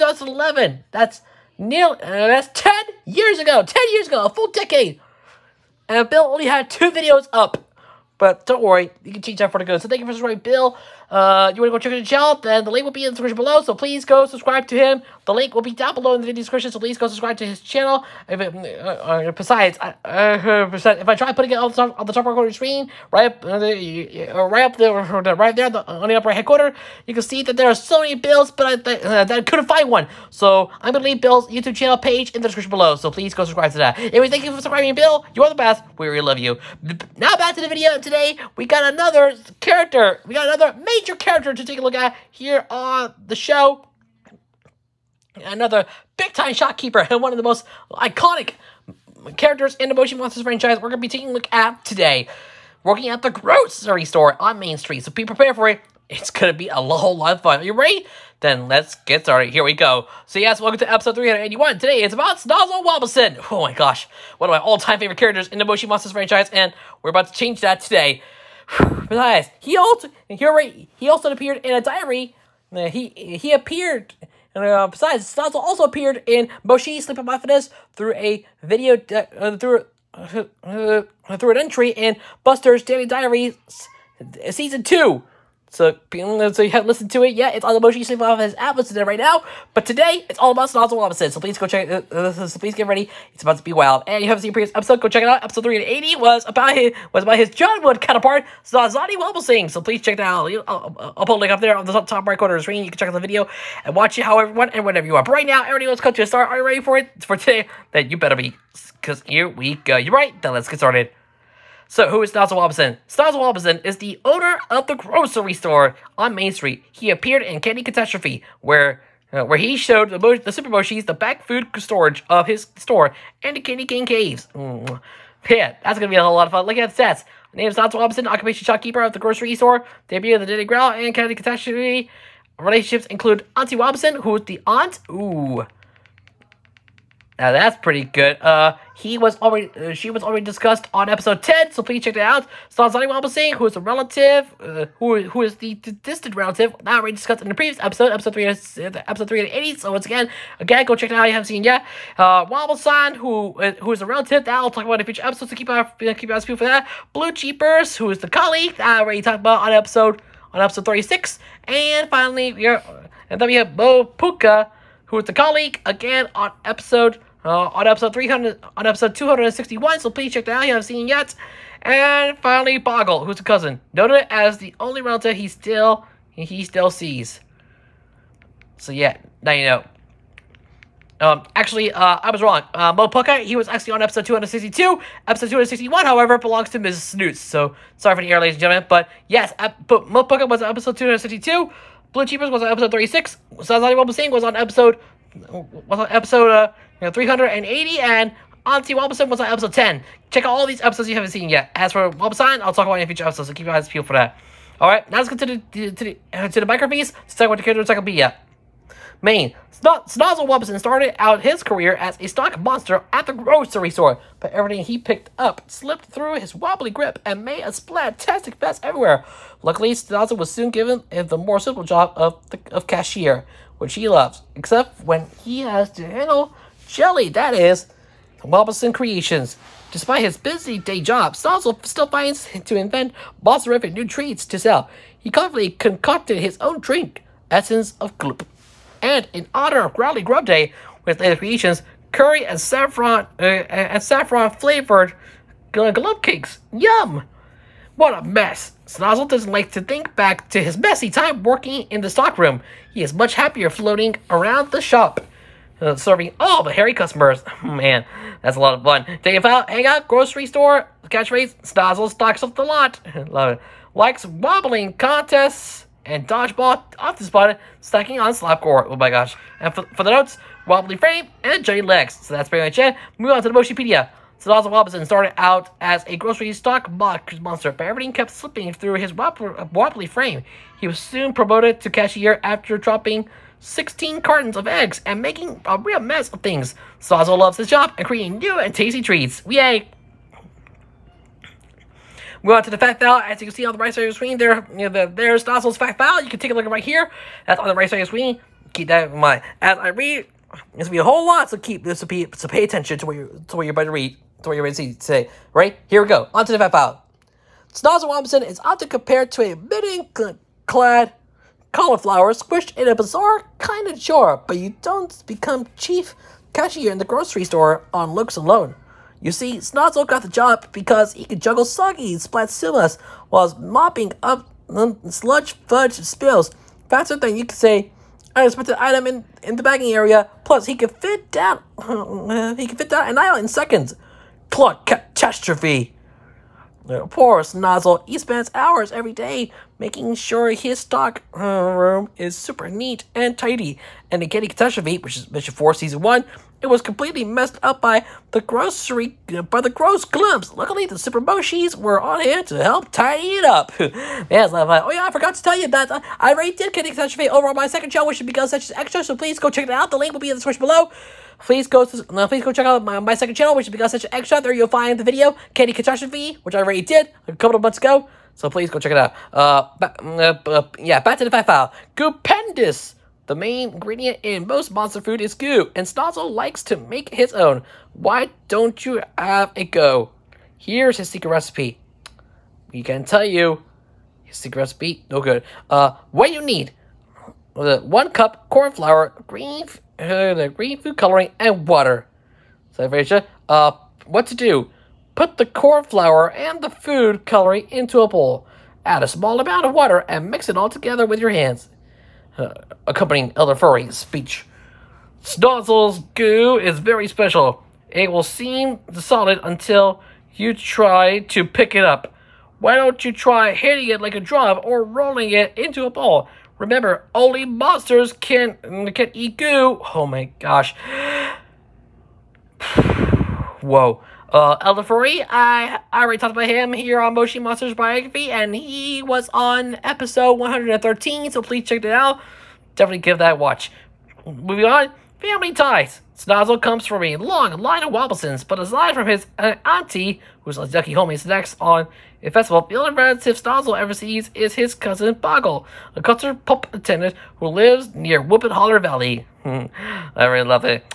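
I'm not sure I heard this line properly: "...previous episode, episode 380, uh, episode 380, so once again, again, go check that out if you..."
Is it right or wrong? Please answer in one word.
right.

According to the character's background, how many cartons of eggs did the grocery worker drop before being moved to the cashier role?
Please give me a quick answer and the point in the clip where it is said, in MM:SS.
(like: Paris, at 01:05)
16, at 04:43.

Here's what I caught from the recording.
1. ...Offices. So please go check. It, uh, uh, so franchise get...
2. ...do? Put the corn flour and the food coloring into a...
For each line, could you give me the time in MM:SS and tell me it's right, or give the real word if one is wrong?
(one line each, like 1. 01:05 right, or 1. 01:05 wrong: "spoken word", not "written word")
1. 01:30 wrong: "please", not "franchise"
2. 06:34 right.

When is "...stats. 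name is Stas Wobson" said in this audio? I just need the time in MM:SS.
02:07.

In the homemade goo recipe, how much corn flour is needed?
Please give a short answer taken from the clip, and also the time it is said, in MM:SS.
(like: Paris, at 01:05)
One cup, at 06:27.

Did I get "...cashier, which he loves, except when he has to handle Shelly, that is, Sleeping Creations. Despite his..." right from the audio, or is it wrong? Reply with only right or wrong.
wrong.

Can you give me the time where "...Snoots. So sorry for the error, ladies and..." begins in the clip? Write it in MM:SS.
03:07.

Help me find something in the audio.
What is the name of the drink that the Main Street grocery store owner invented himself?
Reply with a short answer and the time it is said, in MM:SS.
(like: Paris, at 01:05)
Essence of Gloop, at 03:57.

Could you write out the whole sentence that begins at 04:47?
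Sazo loves his job and creating new and tasty treats.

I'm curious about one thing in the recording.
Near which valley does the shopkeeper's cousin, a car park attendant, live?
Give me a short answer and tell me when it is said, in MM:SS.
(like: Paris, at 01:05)
Whoopin Holler Valley, at 07:28.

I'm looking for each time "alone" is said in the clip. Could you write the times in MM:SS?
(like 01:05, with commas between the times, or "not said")
05:18.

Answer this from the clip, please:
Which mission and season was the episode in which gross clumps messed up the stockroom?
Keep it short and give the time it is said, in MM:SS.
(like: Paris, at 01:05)
Mission 4 Season 1, at 05:45.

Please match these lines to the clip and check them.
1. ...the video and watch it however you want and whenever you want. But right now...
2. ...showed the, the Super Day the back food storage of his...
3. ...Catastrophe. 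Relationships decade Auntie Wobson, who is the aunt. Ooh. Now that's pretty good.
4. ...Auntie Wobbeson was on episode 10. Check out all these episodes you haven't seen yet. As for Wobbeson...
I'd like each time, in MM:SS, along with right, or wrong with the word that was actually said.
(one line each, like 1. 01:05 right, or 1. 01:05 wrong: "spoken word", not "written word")
1. 01:43 right
2. 01:59 wrong: "Moshis", not "Day"
3. 02:11 wrong: "include", not "decade"
4. 03:18 right.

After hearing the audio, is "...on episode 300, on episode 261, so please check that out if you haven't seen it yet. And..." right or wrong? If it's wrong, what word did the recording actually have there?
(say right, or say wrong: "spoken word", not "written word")
right.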